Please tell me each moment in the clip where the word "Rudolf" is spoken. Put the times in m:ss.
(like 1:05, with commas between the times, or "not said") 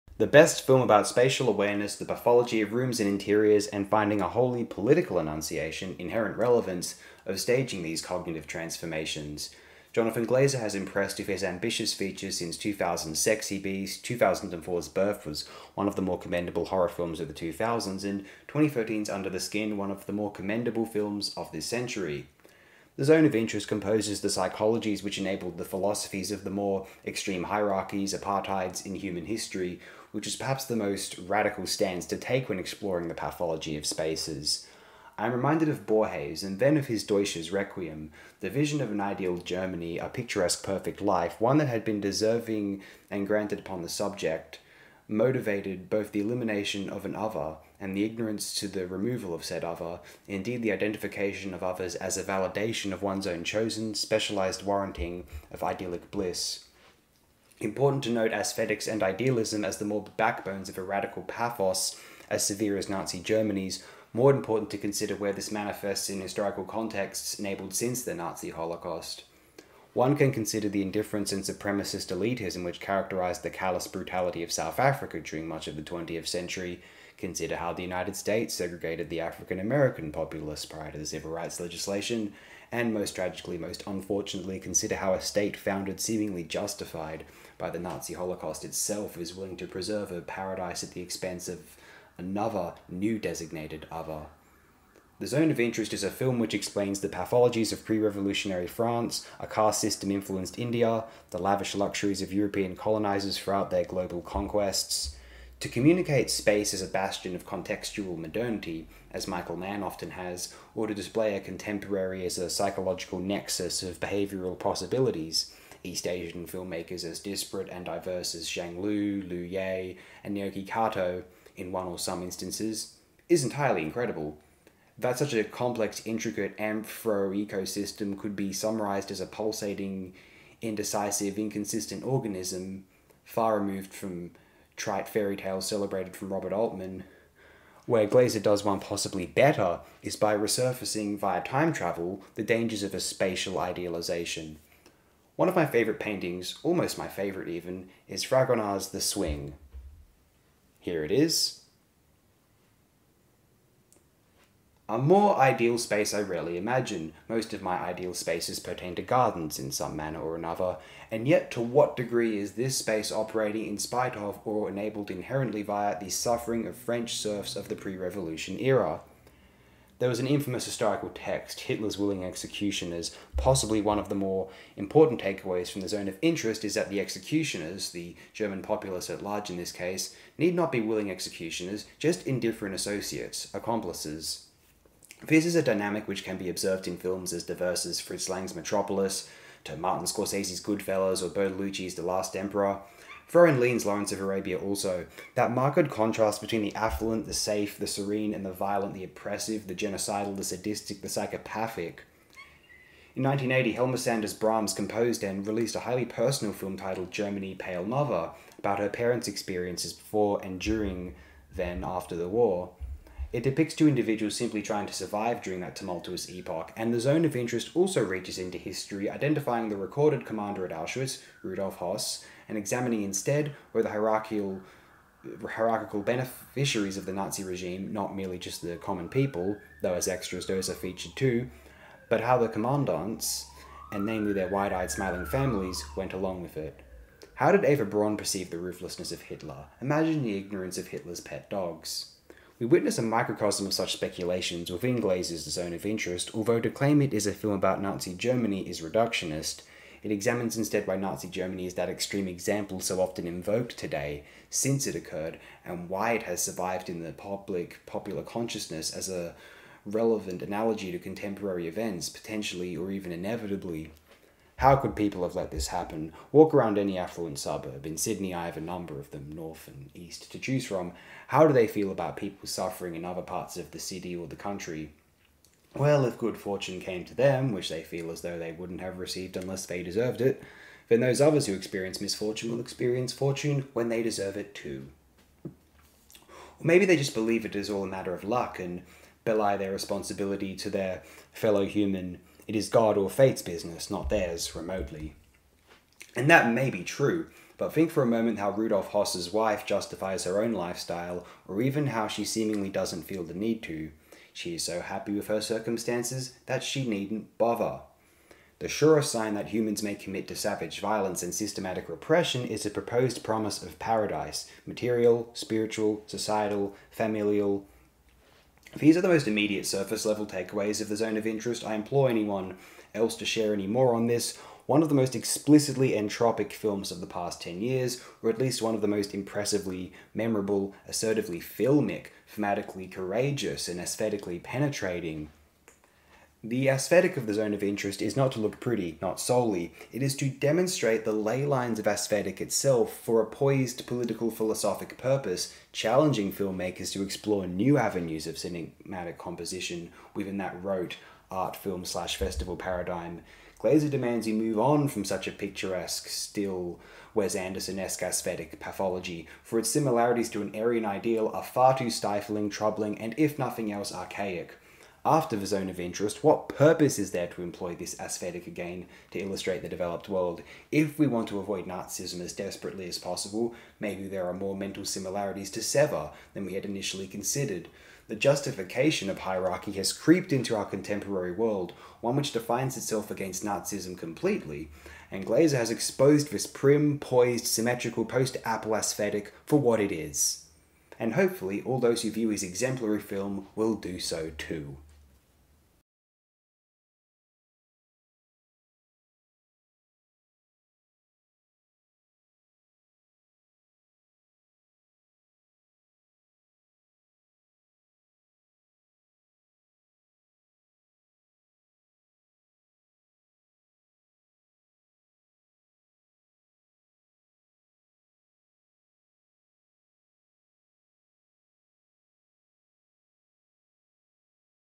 3:41, 4:58.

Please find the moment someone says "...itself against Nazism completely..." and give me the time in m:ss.
6:22.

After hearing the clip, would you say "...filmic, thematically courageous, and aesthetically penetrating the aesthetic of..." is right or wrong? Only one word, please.
right.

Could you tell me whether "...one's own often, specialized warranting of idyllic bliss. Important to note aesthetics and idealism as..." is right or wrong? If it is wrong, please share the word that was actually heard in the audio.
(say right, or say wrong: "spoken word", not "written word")
wrong: "chosen", not "often".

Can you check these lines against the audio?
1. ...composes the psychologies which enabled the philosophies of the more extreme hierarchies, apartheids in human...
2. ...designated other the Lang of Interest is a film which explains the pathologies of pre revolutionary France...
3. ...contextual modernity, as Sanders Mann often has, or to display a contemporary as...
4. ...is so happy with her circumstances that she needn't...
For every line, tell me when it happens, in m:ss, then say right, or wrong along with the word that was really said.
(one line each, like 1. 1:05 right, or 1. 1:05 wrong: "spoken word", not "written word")
1. 0:23 right
2. 1:33 wrong: "Zone", not "Lang"
3. 1:47 wrong: "Michael", not "Sanders"
4. 5:04 right.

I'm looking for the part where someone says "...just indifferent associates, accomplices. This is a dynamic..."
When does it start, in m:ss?
3:01.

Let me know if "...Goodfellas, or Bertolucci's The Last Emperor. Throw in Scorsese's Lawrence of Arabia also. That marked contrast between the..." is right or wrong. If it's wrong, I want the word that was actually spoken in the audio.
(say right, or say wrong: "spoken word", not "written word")
wrong: "Lean", not "Scorsese".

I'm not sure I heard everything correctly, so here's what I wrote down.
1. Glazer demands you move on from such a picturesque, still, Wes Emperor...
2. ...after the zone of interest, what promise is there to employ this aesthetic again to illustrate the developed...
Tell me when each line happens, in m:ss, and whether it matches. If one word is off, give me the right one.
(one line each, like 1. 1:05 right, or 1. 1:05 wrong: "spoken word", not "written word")
1. 5:53 wrong: "Anderson", not "Emperor"
2. 6:05 wrong: "purpose", not "promise".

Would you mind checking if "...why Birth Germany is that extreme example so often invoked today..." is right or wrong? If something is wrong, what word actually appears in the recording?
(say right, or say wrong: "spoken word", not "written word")
wrong: "Nazi", not "Birth".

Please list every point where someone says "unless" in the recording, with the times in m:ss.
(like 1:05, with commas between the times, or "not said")
4:39.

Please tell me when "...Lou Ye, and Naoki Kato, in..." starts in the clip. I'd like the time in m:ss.
1:59.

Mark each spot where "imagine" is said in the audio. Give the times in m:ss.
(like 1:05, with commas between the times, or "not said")
2:36, 3:59.